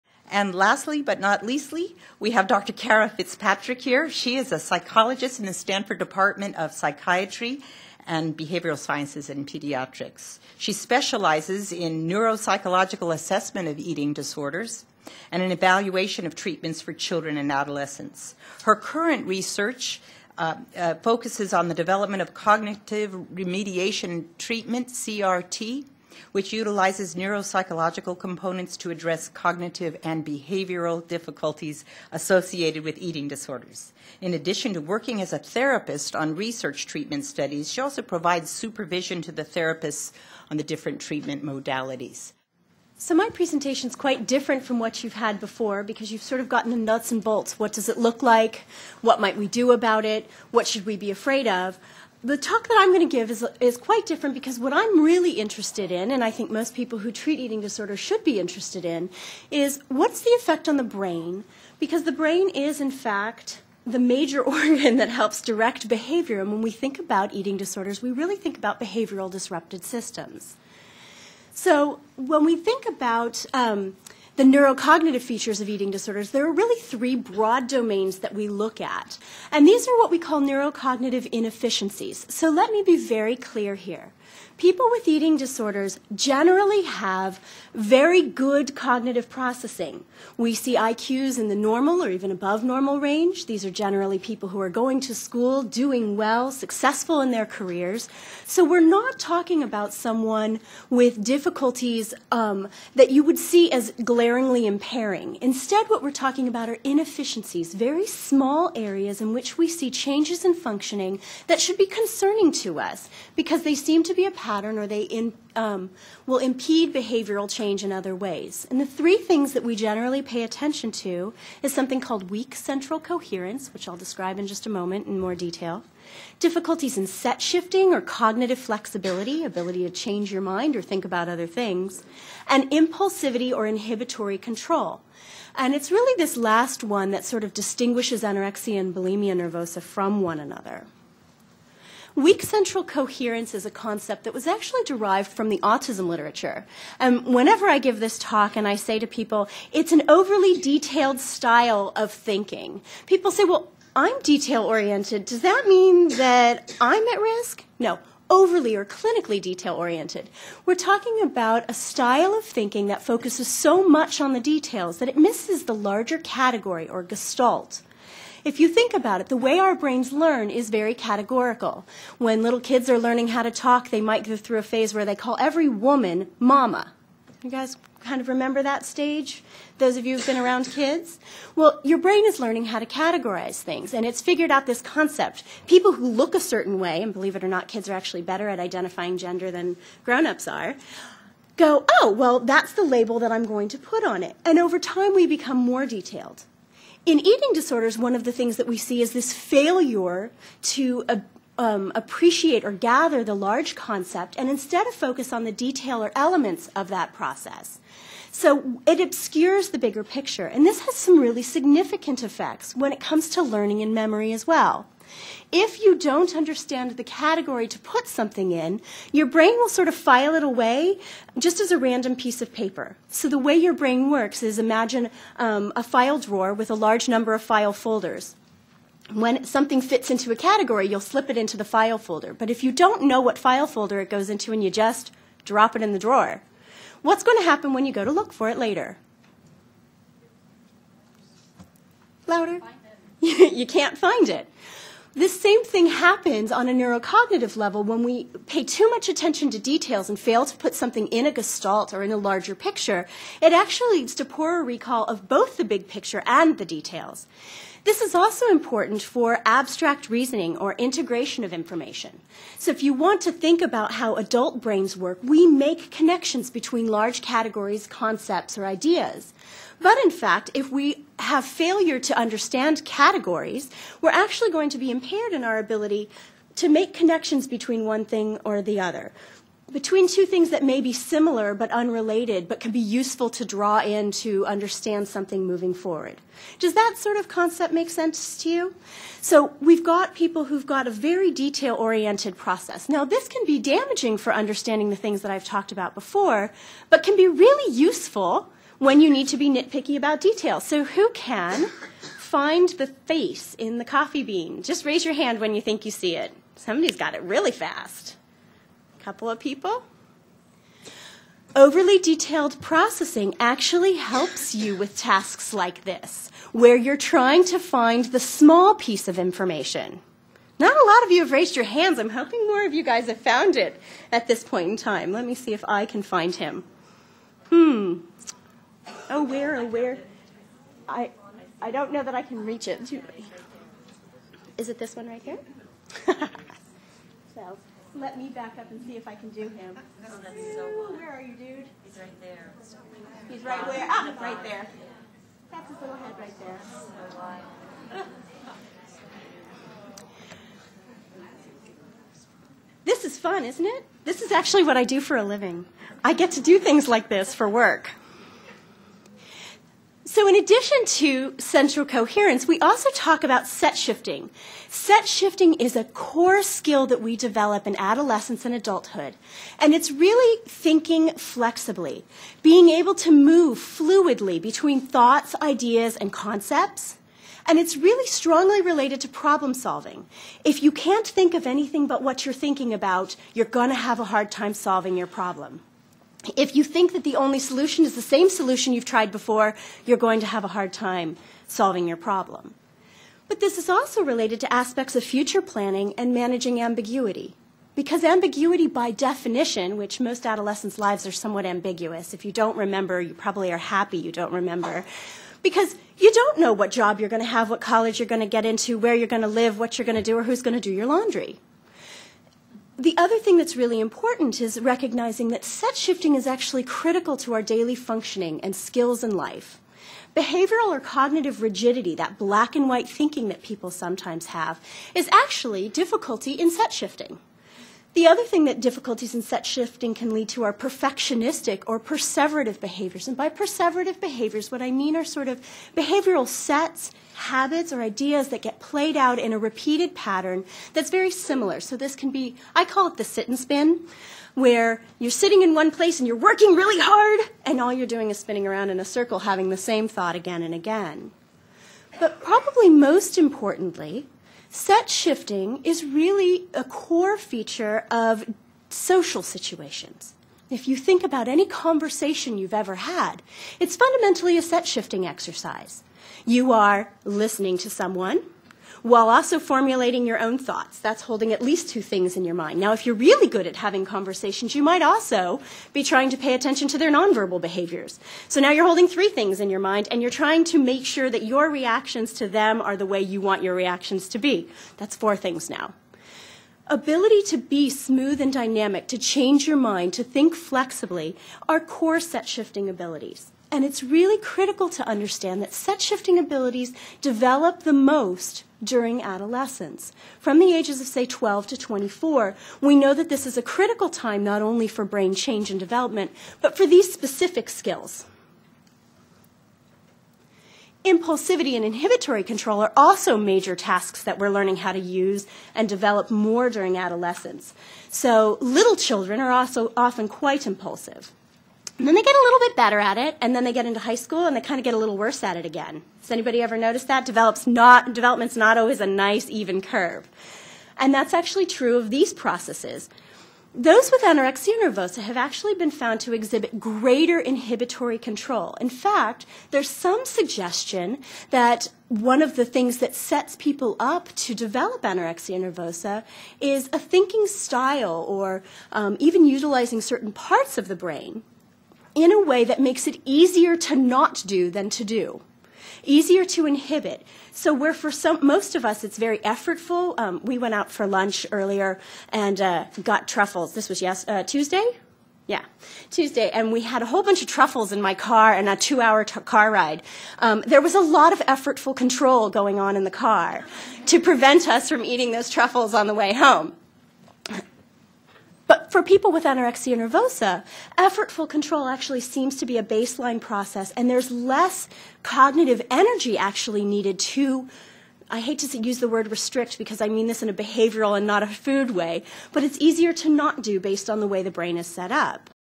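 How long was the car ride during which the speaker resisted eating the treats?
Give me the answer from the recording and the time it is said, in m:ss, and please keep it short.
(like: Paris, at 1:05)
2 hours, at 9:28.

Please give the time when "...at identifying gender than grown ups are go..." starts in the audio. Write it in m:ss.
3:08.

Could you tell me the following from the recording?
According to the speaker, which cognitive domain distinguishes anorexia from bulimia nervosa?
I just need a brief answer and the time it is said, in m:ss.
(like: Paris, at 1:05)
Impulsivity or inhibitory control, at 2:12.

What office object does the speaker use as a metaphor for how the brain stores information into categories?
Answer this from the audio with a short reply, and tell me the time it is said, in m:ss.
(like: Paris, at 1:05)
A file drawer, at 3:45.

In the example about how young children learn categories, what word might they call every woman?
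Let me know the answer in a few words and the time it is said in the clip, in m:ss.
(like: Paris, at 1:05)
Mama, at 2:56.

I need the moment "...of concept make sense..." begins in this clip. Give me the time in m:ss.
4:47.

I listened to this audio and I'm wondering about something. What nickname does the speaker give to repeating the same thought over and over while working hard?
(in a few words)
The sit and spin.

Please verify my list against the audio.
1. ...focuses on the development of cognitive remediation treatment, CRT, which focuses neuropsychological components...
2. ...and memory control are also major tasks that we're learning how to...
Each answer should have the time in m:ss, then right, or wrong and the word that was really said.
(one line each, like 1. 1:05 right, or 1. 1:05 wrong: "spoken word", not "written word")
1. 0:20 wrong: "utilizes", not "focuses"
2. 8:31 wrong: "inhibitory", not "memory".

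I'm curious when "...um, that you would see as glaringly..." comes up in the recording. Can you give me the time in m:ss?
1:42.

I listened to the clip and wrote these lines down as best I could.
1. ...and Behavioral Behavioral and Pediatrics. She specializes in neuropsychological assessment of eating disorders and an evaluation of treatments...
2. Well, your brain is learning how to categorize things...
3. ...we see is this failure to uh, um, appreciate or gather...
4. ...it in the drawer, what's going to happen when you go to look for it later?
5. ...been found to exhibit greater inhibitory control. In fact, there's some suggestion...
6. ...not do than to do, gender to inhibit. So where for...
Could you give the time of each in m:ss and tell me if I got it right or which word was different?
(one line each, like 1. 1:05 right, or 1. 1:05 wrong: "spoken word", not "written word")
1. 0:08 wrong: "Sciences", not "Behavioral"
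2. 3:01 right
3. 3:18 right
4. 3:55 right
5. 8:55 right
6. 9:13 wrong: "easier", not "gender".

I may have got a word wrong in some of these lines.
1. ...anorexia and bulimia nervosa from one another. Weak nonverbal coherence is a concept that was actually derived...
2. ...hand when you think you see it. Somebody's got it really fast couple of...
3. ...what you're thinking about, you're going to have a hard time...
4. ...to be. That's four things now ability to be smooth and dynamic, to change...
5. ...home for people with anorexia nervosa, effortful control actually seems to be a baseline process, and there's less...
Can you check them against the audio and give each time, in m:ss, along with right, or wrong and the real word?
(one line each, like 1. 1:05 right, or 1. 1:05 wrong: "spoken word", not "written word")
1. 2:18 wrong: "central", not "nonverbal"
2. 5:05 right
3. 6:22 right
4. 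8:04 right
5. 9:36 right.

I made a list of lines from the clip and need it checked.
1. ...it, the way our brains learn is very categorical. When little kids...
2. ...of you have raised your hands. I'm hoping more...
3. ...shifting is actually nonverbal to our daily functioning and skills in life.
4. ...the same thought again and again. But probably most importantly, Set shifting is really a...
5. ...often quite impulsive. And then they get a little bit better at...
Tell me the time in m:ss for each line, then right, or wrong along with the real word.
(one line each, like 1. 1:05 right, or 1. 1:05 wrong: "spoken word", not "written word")
1. 2:49 right
2. 5:21 right
3. 6:55 wrong: "critical", not "nonverbal"
4. 7:29 right
5. 8:39 right.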